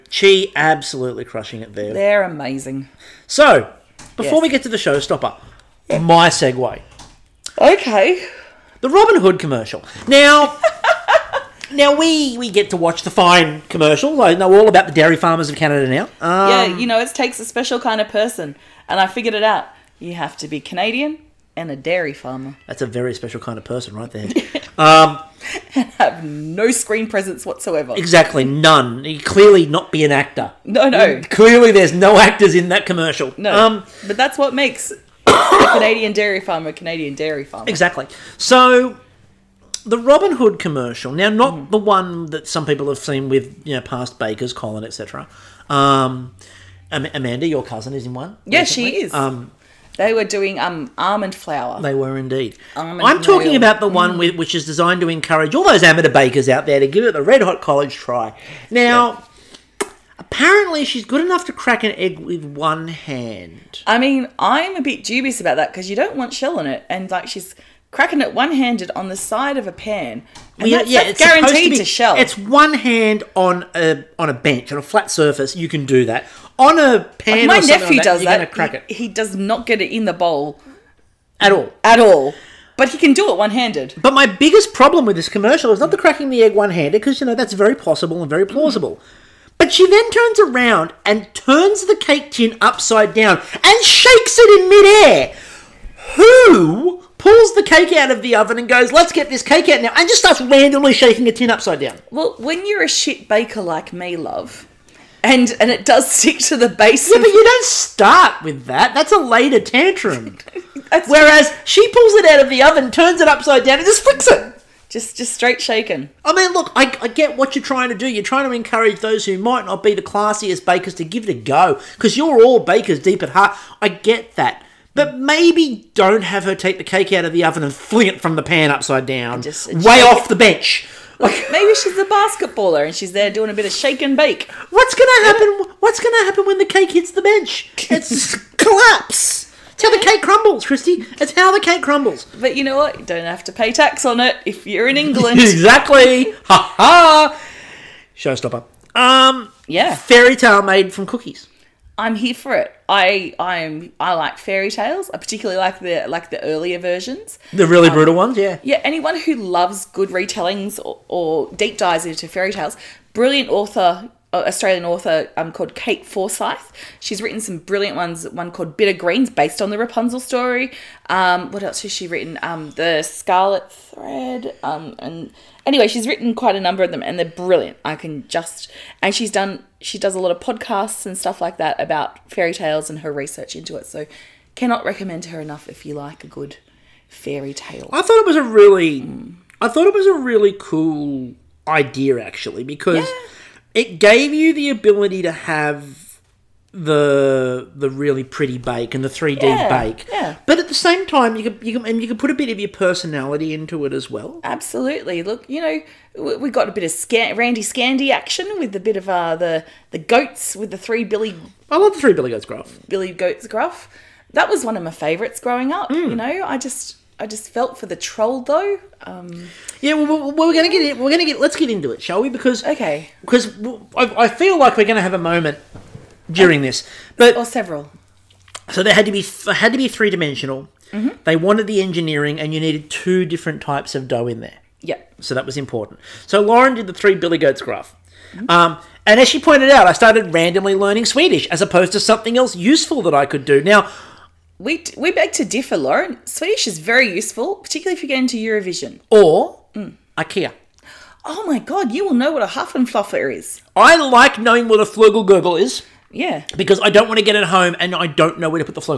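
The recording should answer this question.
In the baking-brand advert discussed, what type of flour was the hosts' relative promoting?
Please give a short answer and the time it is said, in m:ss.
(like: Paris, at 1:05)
Almond flour, at 0:50.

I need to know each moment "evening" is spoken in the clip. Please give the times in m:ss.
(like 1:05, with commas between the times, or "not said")
not said.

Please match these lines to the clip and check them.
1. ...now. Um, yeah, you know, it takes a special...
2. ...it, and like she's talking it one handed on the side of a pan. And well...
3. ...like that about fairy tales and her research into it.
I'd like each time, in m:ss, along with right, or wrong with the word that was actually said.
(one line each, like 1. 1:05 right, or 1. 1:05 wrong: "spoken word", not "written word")
1. 0:15 right
2. 1:06 wrong: "cracking", not "talking"
3. 3:01 right.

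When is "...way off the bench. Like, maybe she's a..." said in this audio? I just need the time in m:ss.
2:09.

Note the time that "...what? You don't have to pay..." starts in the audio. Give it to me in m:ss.
2:22.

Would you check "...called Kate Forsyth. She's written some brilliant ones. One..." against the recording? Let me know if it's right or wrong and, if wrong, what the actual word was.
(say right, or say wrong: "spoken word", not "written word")
right.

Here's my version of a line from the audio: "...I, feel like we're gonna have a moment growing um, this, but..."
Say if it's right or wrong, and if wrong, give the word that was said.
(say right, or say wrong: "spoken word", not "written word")
wrong: "during", not "growing".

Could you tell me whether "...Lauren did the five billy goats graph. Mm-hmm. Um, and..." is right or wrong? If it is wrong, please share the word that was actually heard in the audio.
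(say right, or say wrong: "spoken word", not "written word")
wrong: "three", not "five".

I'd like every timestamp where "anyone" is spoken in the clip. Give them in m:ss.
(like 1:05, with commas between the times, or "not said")
2:38.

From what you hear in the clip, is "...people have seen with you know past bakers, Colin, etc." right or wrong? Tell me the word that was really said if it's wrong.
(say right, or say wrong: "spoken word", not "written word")
right.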